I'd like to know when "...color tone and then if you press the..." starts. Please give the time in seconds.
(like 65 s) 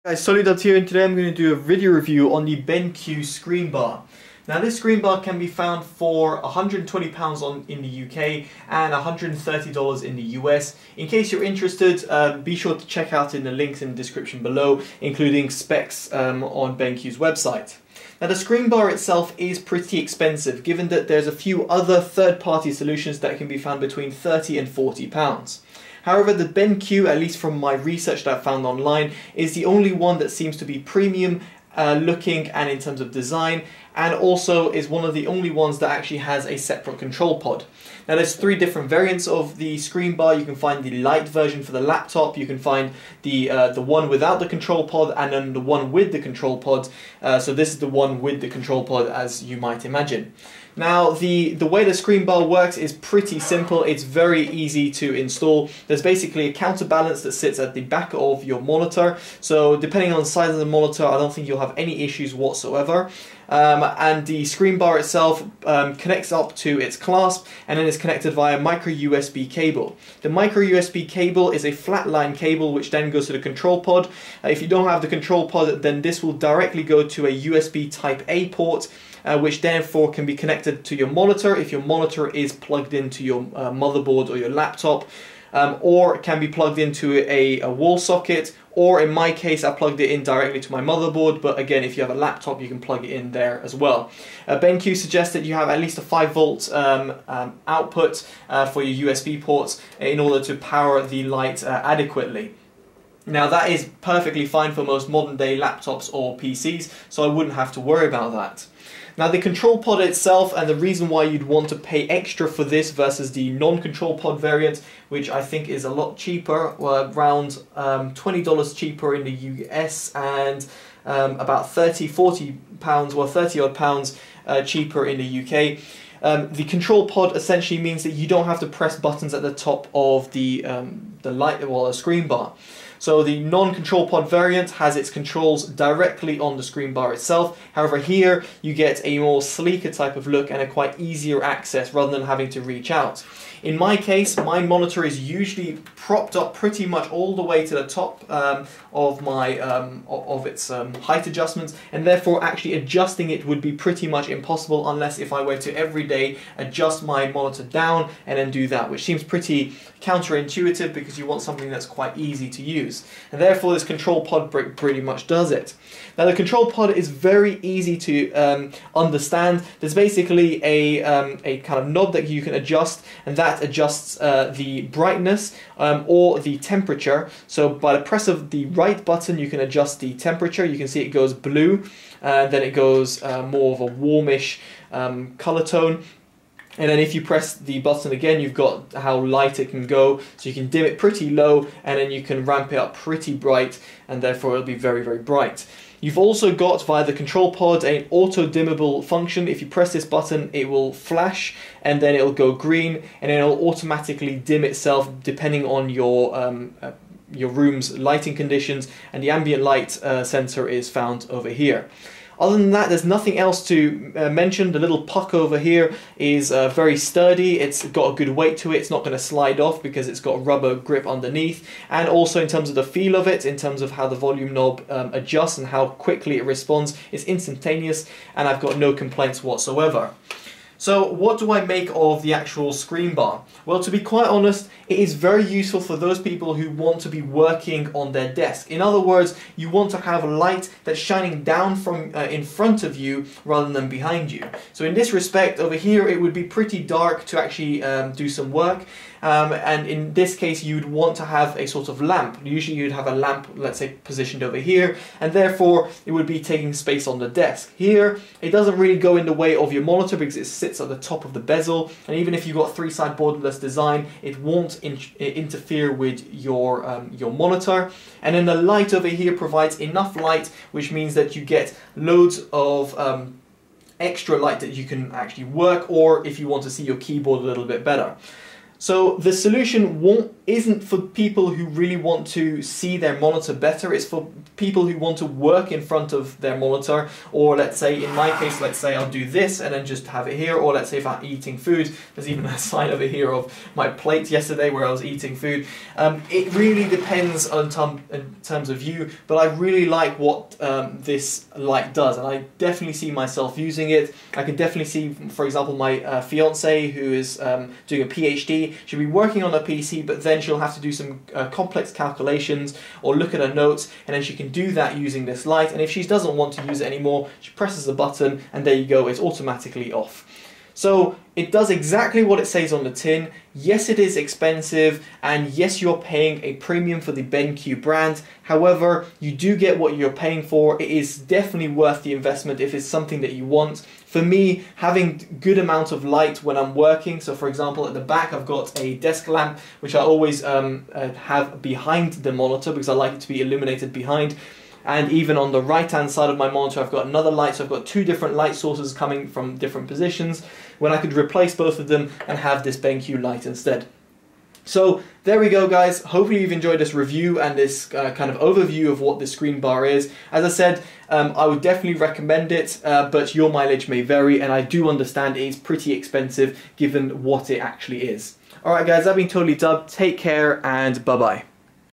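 185 s.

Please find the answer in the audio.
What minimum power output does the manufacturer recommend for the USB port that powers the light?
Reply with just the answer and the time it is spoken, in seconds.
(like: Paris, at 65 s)
5 volts, at 96 s.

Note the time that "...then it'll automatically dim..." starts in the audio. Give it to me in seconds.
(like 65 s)
203 s.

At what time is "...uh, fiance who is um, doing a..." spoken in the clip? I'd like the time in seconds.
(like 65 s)
306 s.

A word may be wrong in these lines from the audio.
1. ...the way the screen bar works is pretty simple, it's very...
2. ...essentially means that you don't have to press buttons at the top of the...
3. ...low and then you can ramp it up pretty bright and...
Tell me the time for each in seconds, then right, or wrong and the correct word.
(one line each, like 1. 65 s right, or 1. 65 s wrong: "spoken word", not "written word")
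1. 51 s right
2. 127 s right
3. 191 s right.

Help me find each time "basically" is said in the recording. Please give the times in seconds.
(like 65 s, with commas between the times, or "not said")
56 s, 169 s.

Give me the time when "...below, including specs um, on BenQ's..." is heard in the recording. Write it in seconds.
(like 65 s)
14 s.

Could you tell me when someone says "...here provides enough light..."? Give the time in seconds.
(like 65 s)
269 s.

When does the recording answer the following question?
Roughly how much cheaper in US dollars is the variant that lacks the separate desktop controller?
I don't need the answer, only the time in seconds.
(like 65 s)
118 s.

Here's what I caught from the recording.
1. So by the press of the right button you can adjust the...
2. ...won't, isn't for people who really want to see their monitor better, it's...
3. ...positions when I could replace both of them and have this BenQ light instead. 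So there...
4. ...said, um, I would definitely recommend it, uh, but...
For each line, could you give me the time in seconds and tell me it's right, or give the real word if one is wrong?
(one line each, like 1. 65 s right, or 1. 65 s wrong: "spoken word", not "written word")
1. 177 s right
2. 280 s right
3. 349 s right
4. 360 s right.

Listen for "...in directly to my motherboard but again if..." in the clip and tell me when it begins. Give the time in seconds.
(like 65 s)
90 s.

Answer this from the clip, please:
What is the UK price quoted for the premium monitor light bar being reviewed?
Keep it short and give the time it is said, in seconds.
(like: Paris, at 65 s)
£120, at 6 s.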